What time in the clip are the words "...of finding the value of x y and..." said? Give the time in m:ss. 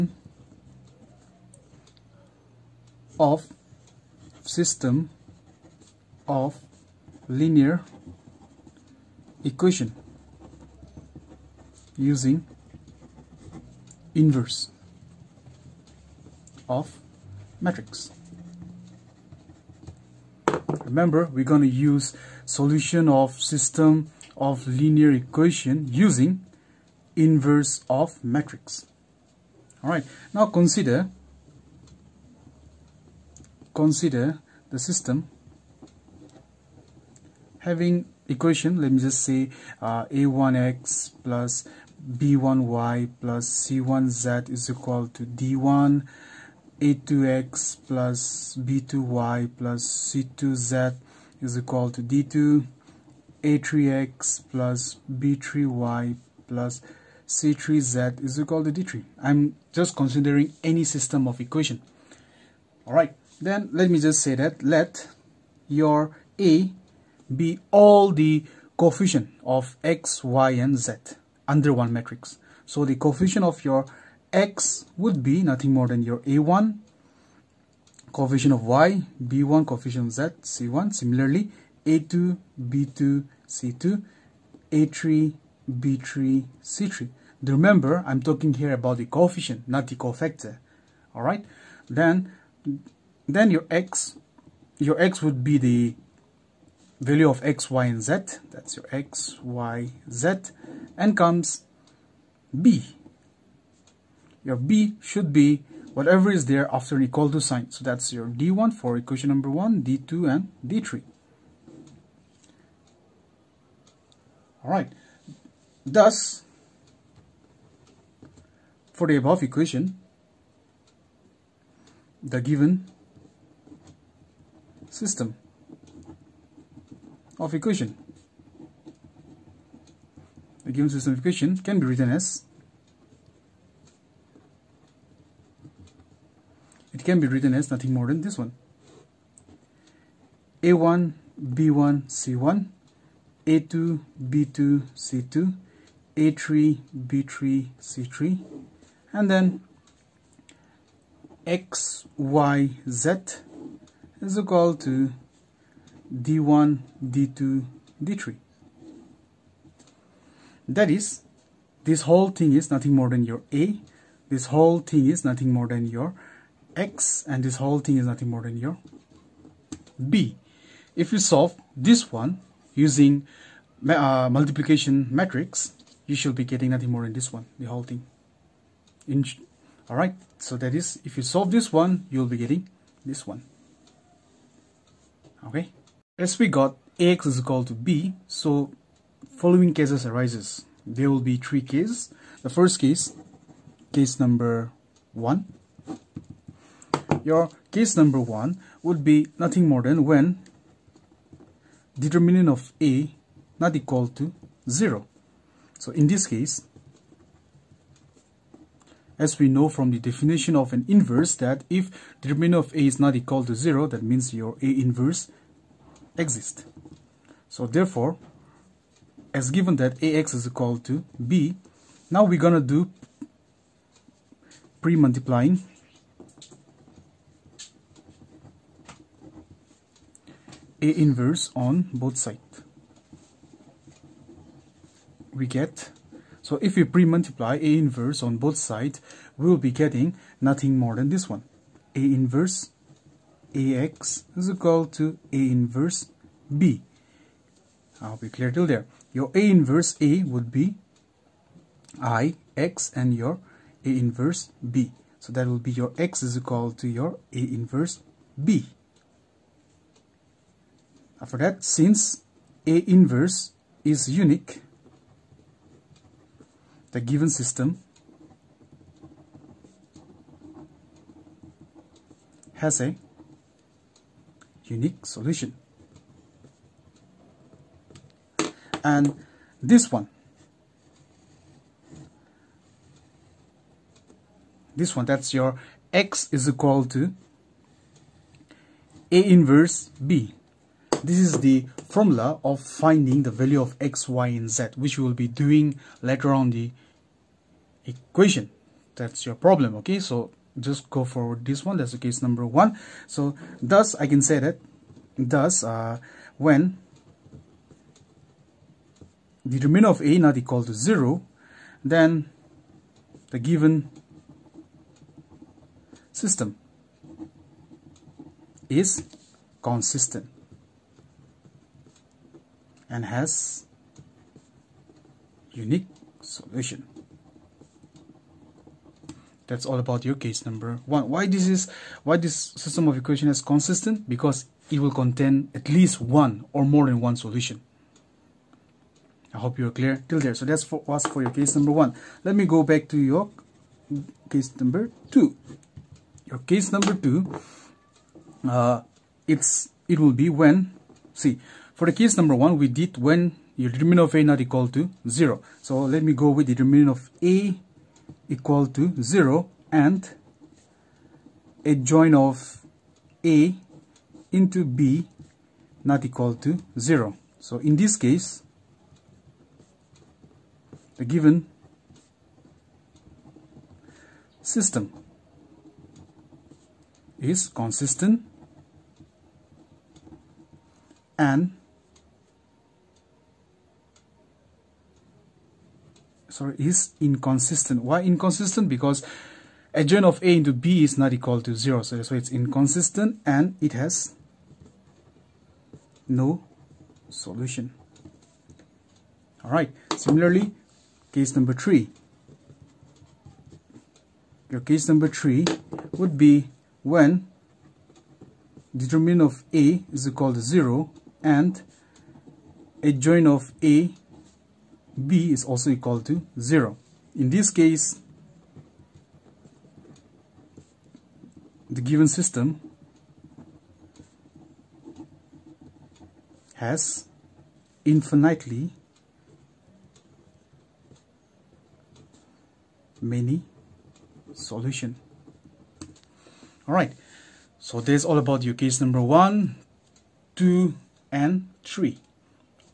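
4:52.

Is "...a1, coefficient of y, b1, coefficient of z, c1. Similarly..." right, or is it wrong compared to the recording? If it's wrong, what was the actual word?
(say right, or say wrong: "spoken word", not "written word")
right.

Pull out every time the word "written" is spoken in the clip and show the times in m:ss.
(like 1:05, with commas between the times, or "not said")
2:11, 2:17.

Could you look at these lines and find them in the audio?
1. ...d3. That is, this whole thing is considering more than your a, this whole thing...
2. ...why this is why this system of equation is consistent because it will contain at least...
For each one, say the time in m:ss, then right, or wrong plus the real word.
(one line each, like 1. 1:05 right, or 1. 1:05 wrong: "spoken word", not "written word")
1. 2:38 wrong: "nothing", not "considering"
2. 5:31 right.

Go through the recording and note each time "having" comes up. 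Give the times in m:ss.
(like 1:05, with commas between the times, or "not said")
0:37.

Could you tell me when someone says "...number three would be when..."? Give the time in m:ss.
6:44.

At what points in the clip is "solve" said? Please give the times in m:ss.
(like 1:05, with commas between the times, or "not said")
2:51, 3:01.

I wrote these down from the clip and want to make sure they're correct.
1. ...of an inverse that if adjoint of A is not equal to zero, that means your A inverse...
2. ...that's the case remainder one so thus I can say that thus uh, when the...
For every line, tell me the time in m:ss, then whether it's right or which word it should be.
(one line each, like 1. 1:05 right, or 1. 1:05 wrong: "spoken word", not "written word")
1. 3:30 wrong: "determinant", not "adjoint"
2. 5:01 wrong: "number", not "remainder".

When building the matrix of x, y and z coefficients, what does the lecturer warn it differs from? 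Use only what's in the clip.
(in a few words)
the cofactor.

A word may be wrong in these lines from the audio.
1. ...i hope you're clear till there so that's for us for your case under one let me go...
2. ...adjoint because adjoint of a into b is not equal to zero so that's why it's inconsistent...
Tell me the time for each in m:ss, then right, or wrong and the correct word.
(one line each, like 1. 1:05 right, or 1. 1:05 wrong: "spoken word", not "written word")
1. 5:39 wrong: "number", not "under"
2. 6:28 wrong: "inconsistent", not "adjoint".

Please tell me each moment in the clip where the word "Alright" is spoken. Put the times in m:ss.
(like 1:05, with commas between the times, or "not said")
0:29, 1:54.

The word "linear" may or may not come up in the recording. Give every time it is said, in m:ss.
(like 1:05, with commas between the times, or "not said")
0:07, 0:24.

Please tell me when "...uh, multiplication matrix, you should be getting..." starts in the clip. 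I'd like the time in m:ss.
2:53.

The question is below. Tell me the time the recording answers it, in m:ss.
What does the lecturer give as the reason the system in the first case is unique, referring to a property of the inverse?
4:22.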